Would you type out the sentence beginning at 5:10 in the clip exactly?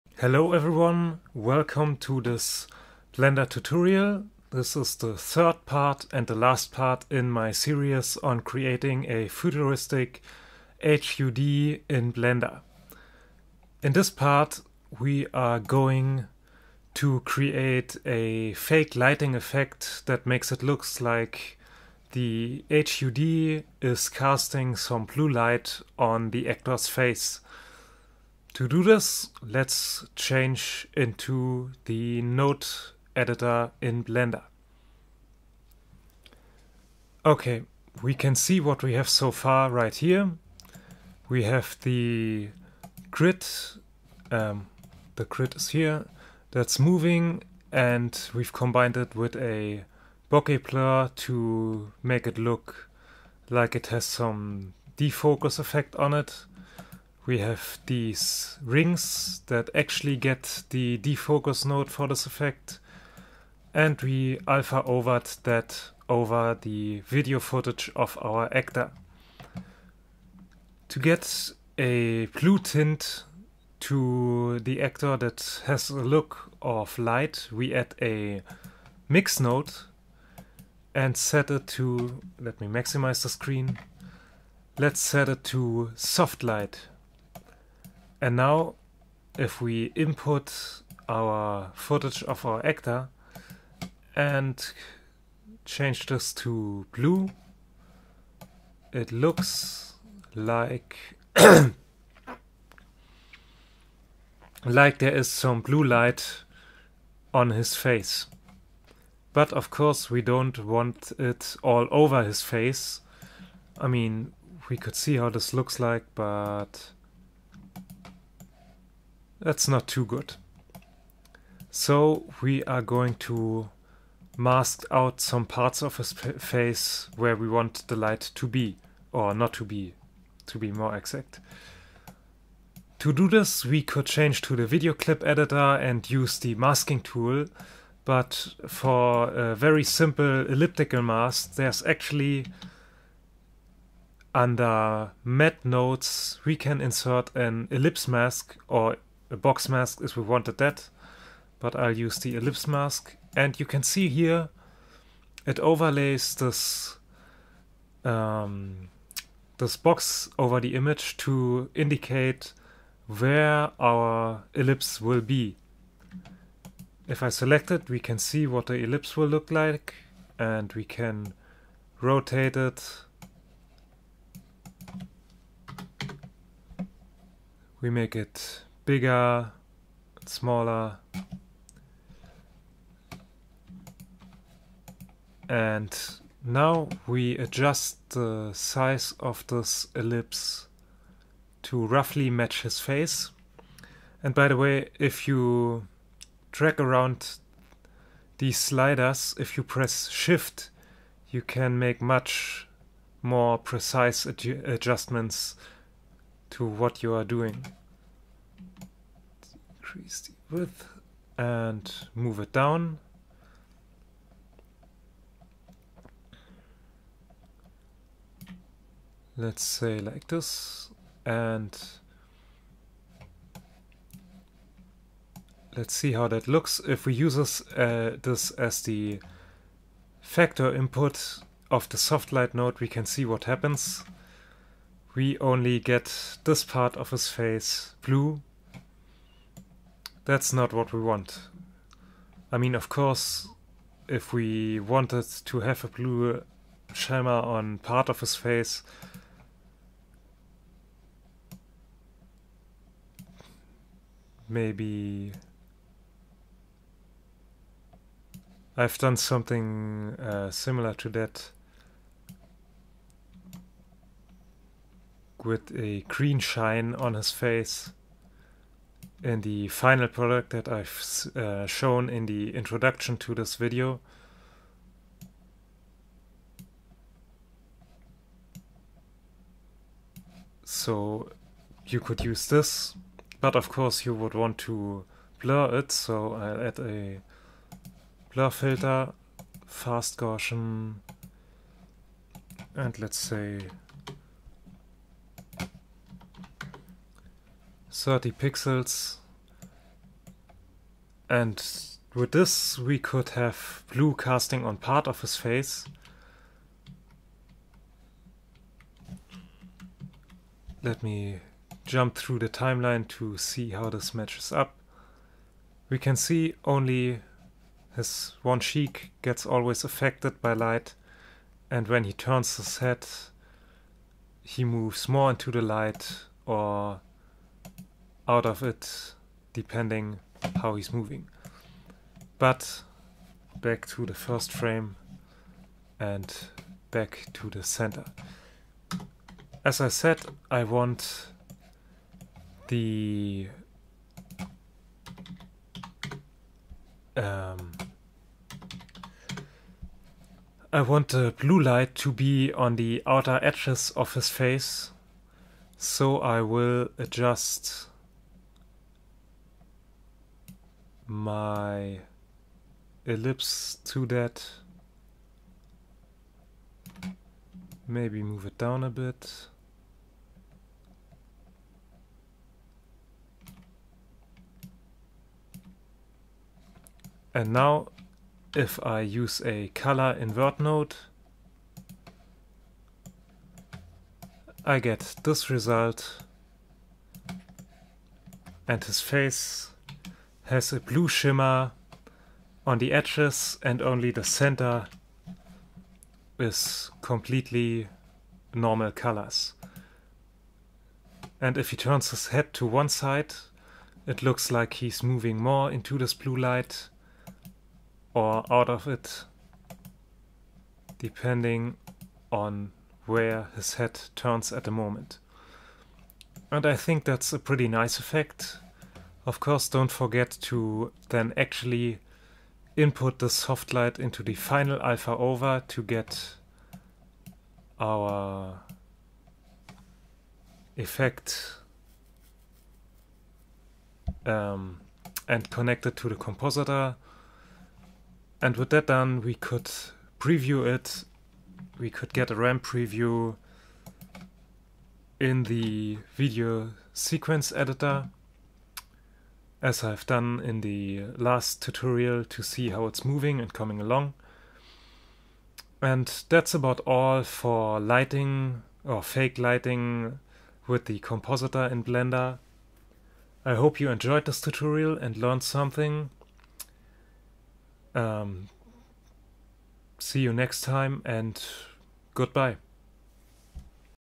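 Let me jump through the timeline to see how this matches up.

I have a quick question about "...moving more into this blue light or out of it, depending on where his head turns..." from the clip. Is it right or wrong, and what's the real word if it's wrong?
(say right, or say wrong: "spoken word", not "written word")
right.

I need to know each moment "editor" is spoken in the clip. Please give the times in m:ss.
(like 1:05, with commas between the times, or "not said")
0:33, 2:15, 7:27.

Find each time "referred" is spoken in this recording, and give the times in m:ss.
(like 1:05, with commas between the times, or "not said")
not said.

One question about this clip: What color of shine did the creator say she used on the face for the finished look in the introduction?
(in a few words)
Green.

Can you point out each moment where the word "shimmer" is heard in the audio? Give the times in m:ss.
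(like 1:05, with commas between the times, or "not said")
4:06, 6:31.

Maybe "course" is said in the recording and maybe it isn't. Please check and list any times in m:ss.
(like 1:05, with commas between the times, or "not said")
1:49, 4:02, 4:43, 6:59.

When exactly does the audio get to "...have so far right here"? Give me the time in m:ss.
0:38.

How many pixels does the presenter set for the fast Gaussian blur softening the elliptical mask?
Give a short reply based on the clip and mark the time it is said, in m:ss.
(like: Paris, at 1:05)
30, at 4:57.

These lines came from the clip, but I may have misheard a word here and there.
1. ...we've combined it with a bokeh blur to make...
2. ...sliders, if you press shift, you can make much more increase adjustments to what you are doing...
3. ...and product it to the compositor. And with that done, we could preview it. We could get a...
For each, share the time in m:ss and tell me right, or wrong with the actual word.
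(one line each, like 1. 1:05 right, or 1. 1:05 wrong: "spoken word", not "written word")
1. 0:48 right
2. 3:18 wrong: "precise", not "increase"
3. 7:15 wrong: "connect", not "product".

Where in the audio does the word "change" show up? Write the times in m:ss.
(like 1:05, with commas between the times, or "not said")
0:30, 1:35, 2:14.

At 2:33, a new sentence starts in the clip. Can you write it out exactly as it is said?
And you can see here, it overlays this um, this box over the image to indicate where our ellipse will be.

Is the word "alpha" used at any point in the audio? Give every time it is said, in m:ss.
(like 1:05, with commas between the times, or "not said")
1:04, 7:04.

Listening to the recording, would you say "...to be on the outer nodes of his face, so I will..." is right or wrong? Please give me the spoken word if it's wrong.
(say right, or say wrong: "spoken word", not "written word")
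wrong: "edges", not "nodes".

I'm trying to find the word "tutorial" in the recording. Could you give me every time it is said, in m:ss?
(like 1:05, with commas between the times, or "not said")
0:03, 7:31, 7:44.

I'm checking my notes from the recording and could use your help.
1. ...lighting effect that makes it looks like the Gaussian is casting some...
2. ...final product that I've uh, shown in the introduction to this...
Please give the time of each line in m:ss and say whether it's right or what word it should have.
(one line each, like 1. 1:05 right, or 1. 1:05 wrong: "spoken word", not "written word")
1. 0:18 wrong: "HUD", not "Gaussian"
2. 4:29 right.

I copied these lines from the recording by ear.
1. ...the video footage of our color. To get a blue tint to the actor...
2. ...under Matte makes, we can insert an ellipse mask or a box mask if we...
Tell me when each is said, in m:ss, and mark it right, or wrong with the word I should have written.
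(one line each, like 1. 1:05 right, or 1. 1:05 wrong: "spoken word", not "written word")
1. 1:06 wrong: "actor", not "color"
2. 2:24 wrong: "nodes", not "makes".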